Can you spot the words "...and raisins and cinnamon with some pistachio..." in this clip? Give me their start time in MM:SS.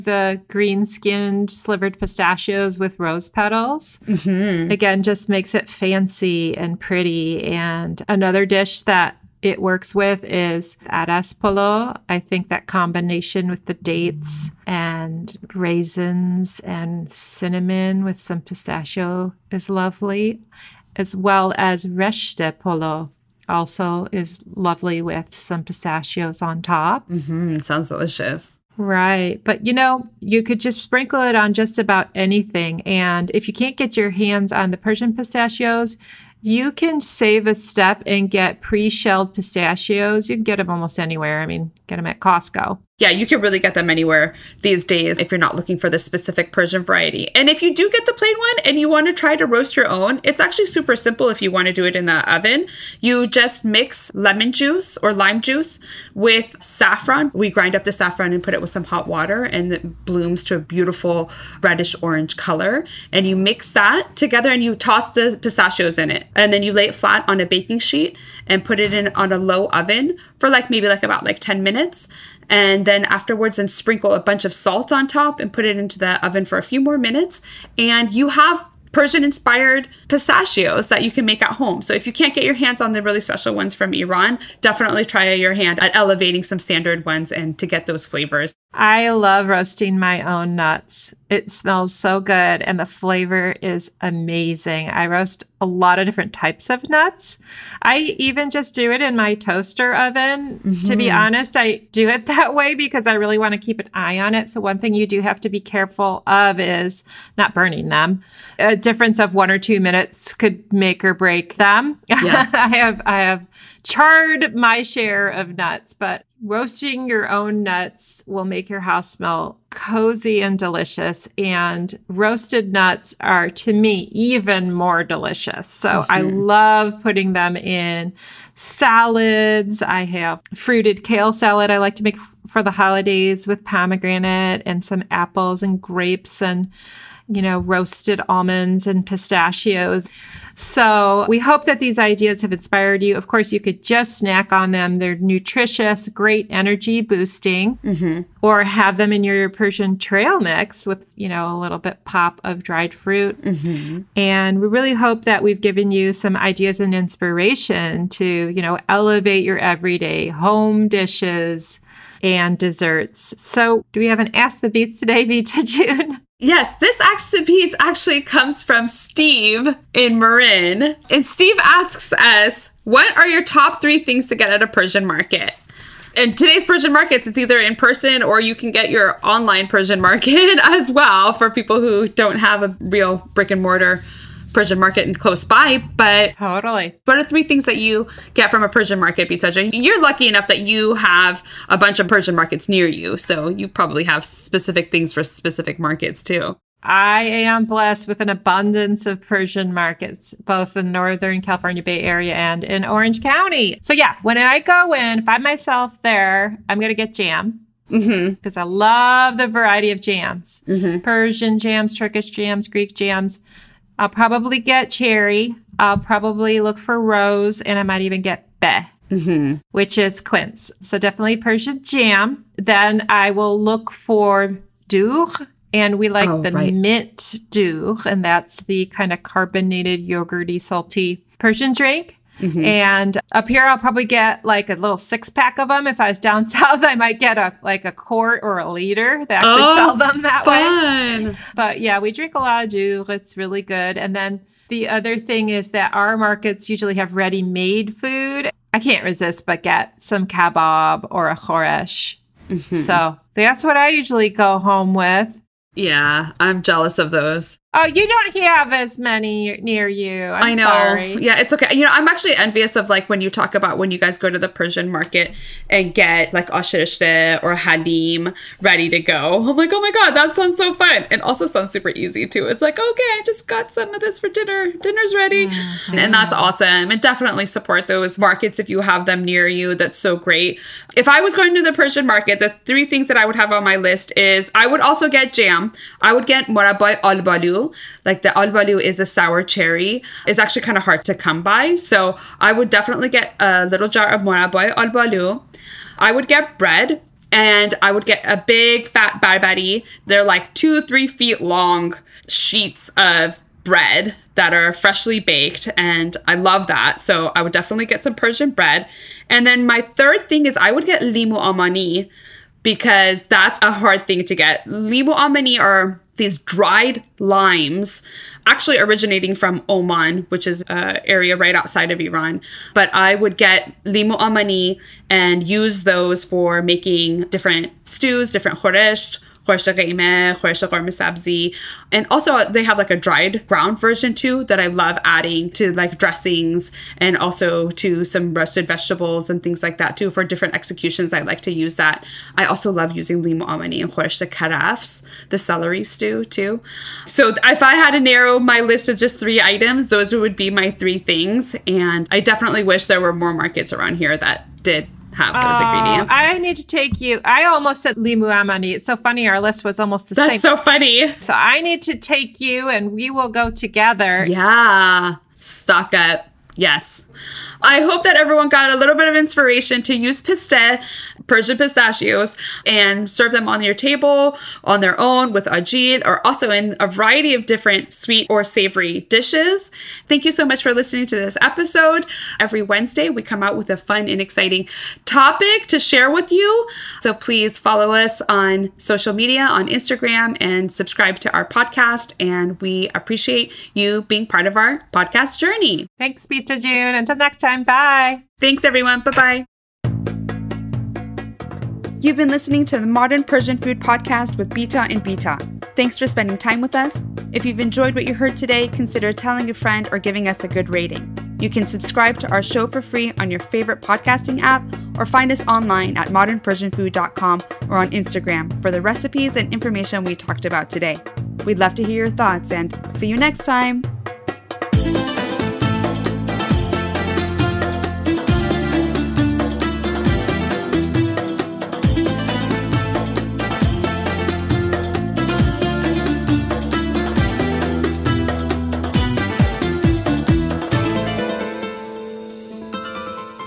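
00:14.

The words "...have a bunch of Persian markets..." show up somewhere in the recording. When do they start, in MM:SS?
03:10.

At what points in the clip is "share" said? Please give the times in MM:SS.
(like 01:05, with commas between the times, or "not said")
01:54, 06:25.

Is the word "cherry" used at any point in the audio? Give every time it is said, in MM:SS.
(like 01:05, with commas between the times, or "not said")
03:34, 04:49.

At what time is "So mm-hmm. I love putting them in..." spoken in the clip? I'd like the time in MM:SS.
02:05.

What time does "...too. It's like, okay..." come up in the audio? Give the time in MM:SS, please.
04:32.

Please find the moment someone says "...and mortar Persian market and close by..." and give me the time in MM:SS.
03:03.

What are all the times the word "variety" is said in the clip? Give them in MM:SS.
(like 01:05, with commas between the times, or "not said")
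00:46, 03:29, 06:16.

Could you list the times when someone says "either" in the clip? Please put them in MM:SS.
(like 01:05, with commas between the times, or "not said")
02:57.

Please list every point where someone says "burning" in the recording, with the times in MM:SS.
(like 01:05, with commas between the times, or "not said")
01:47.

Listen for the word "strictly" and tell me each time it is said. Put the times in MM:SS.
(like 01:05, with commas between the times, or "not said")
not said.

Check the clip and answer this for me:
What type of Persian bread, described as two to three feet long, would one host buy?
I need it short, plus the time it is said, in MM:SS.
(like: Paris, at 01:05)
Barbari, at 04:59.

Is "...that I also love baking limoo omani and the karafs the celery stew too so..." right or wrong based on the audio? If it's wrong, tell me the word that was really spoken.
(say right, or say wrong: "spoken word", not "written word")
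wrong: "using", not "baking".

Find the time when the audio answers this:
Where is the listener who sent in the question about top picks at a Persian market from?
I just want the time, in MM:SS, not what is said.
02:50.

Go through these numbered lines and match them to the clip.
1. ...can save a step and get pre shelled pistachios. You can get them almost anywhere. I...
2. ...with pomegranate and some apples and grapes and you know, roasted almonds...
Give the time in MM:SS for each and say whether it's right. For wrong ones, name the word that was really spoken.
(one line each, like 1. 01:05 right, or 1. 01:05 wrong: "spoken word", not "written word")
1. 00:36 right
2. 02:13 right.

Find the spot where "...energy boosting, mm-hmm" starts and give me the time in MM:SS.
02:26.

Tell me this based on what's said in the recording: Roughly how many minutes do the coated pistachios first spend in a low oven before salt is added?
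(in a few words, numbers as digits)
10.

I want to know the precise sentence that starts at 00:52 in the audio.
You just mix lemon juice or lime juice with saffron.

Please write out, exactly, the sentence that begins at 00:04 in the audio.
Again, just makes it fancy and pretty.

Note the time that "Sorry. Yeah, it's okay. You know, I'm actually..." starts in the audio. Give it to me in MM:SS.
04:20.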